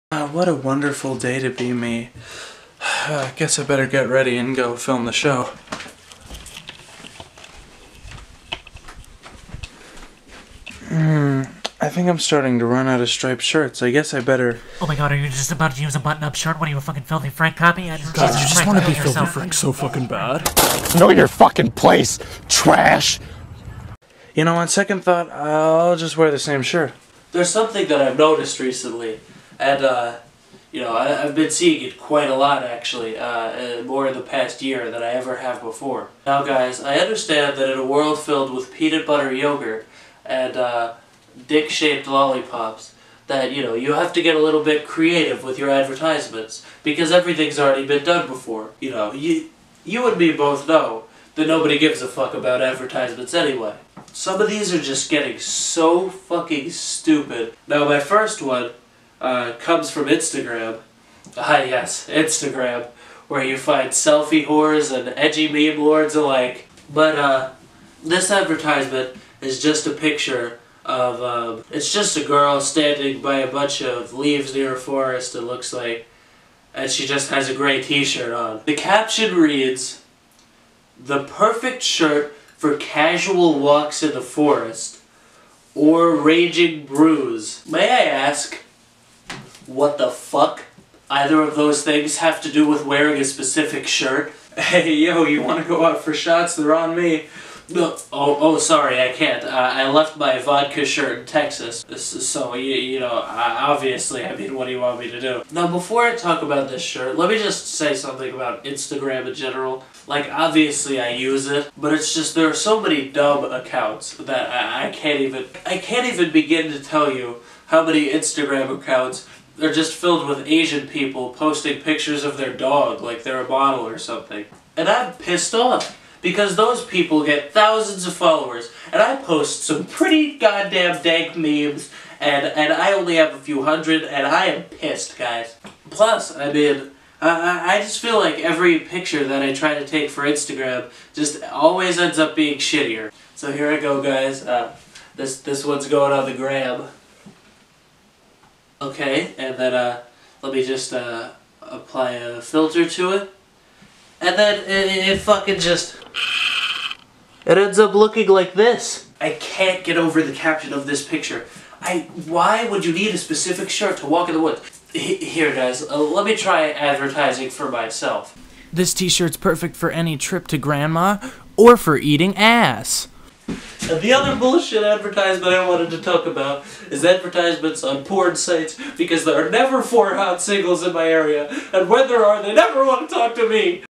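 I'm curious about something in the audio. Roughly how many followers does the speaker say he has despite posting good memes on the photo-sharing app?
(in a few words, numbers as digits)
a few hundred.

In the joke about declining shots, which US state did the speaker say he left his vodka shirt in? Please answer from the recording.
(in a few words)
Texas.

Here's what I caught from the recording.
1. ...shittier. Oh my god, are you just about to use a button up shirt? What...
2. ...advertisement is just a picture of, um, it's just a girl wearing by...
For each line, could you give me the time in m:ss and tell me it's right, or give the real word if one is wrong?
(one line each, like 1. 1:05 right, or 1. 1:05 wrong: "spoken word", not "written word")
1. 0:14 wrong: "better", not "shittier"
2. 1:08 wrong: "standing", not "wearing".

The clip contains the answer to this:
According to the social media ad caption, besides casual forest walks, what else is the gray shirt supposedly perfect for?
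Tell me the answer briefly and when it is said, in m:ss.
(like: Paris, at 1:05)
raging brews, at 1:26.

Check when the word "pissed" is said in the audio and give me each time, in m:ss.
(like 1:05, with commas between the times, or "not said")
2:05, 2:14.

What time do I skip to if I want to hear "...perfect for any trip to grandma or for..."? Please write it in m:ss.
2:49.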